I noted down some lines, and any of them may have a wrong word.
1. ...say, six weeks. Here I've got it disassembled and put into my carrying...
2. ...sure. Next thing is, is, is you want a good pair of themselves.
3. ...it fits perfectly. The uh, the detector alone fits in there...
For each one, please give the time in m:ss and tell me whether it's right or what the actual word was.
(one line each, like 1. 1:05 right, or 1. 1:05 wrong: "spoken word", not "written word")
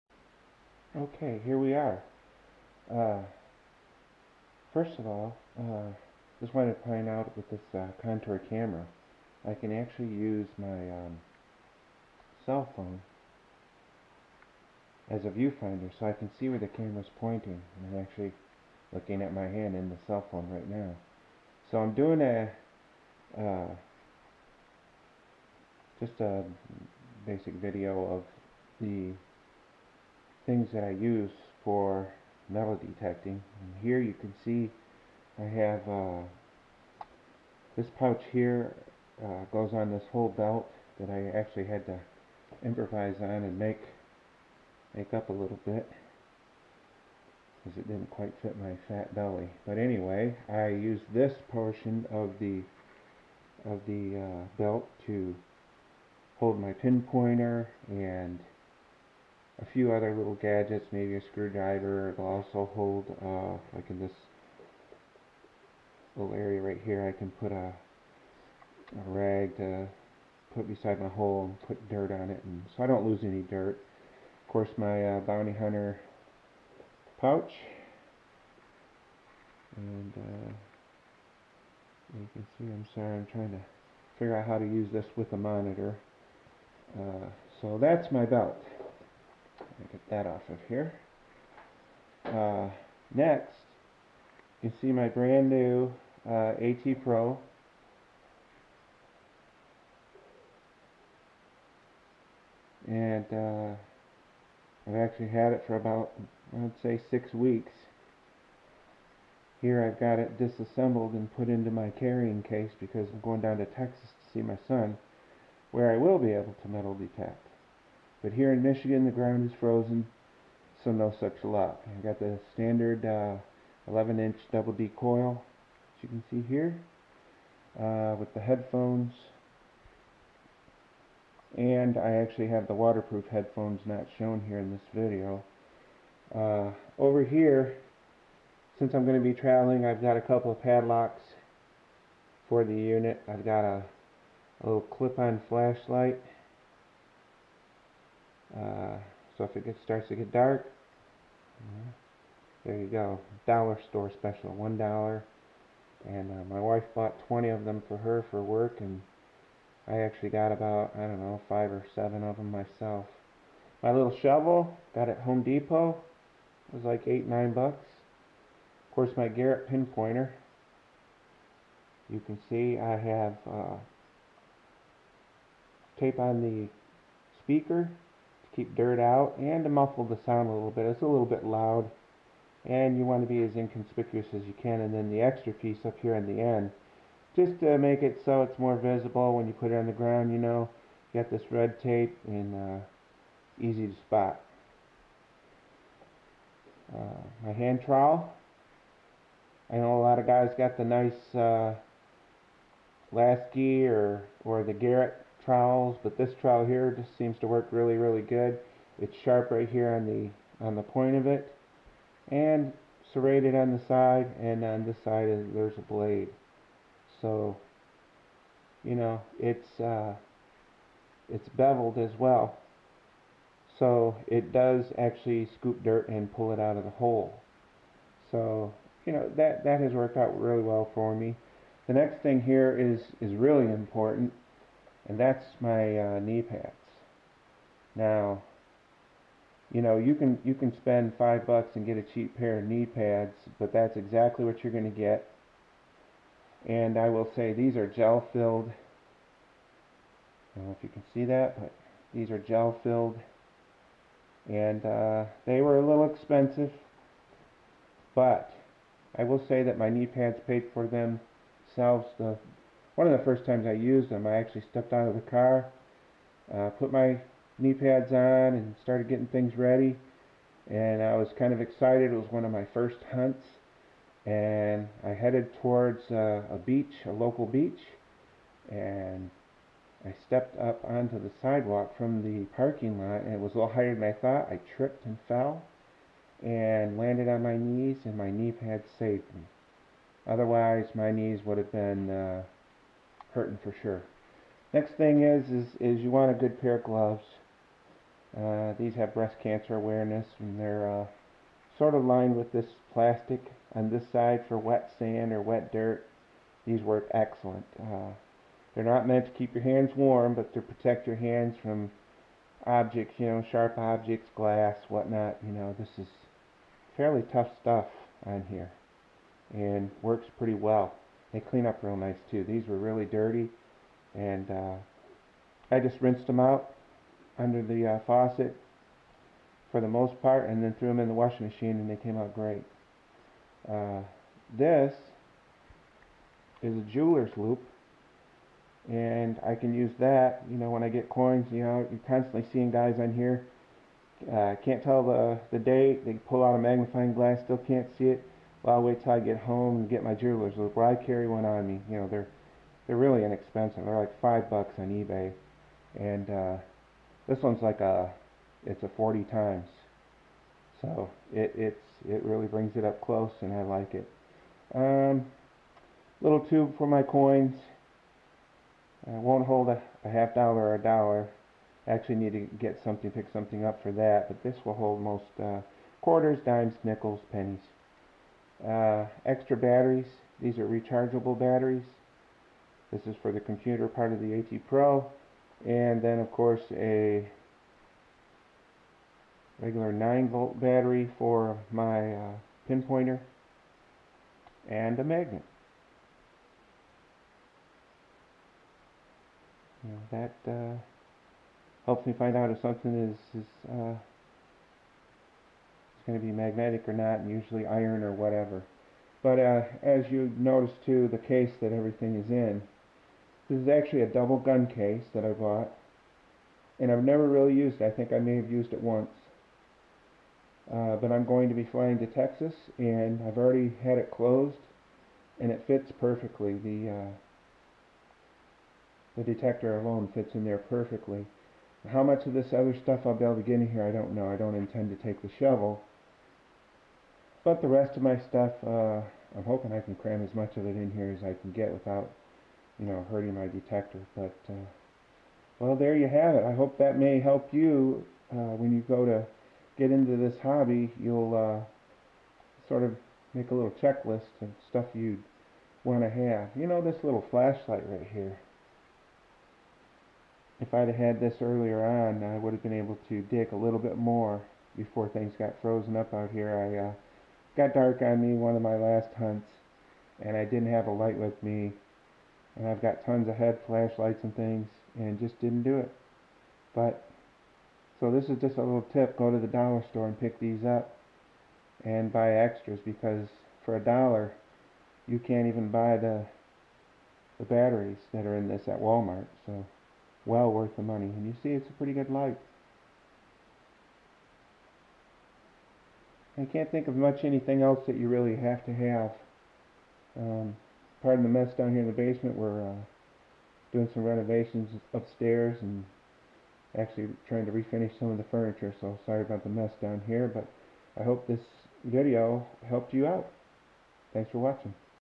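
1. 1:46 right
2. 4:53 wrong: "gloves", not "themselves"
3. 7:05 right.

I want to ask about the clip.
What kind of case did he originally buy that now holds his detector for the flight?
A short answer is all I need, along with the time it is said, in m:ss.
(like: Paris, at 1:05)
double gun case, at 6:54.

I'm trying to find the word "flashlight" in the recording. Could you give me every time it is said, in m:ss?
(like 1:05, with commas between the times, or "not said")
2:25, 7:37, 7:53.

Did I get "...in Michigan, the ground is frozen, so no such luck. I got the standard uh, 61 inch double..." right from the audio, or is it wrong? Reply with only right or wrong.
wrong.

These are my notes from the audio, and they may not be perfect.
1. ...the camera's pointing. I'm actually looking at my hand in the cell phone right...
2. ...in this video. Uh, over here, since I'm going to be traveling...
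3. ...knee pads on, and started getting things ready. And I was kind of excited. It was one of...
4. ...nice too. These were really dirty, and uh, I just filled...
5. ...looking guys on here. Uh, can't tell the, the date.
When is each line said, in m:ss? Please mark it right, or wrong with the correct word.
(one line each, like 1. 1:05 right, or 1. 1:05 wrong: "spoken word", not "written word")
1. 0:16 right
2. 2:14 right
3. 4:27 right
4. 5:21 wrong: "rinsed", not "filled"
5. 5:42 wrong: "seeing", not "looking".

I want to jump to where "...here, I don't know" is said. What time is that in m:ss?
7:13.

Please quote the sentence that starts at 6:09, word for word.
I uh, won't hold a, a half dollar or a dollar.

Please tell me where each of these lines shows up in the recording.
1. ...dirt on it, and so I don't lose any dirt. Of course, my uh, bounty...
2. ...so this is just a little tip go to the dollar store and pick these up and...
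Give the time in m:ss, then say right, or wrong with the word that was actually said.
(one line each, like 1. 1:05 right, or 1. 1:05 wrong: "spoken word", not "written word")
1. 1:11 right
2. 7:57 right.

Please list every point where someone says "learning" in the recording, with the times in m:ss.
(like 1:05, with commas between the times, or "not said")
not said.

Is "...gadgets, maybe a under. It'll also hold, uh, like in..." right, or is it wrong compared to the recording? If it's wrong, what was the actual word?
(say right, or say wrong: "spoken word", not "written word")
wrong: "screwdriver", not "under".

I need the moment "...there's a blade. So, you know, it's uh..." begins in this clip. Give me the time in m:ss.
3:35.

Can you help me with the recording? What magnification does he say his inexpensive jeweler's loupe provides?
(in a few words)
40 times.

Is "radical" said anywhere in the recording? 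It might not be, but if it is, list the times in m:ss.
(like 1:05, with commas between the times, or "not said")
not said.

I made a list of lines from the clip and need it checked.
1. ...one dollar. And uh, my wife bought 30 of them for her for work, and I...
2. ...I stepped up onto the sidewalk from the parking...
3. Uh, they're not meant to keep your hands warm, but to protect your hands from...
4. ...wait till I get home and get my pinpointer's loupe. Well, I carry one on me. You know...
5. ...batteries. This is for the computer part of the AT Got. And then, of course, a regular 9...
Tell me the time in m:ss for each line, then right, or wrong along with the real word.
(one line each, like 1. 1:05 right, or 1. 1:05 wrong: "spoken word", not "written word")
1. 2:34 wrong: "20", not "30"
2. 4:40 right
3. 5:07 right
4. 5:48 wrong: "jeweler", not "pinpointer"
5. 6:21 wrong: "Pro", not "Got".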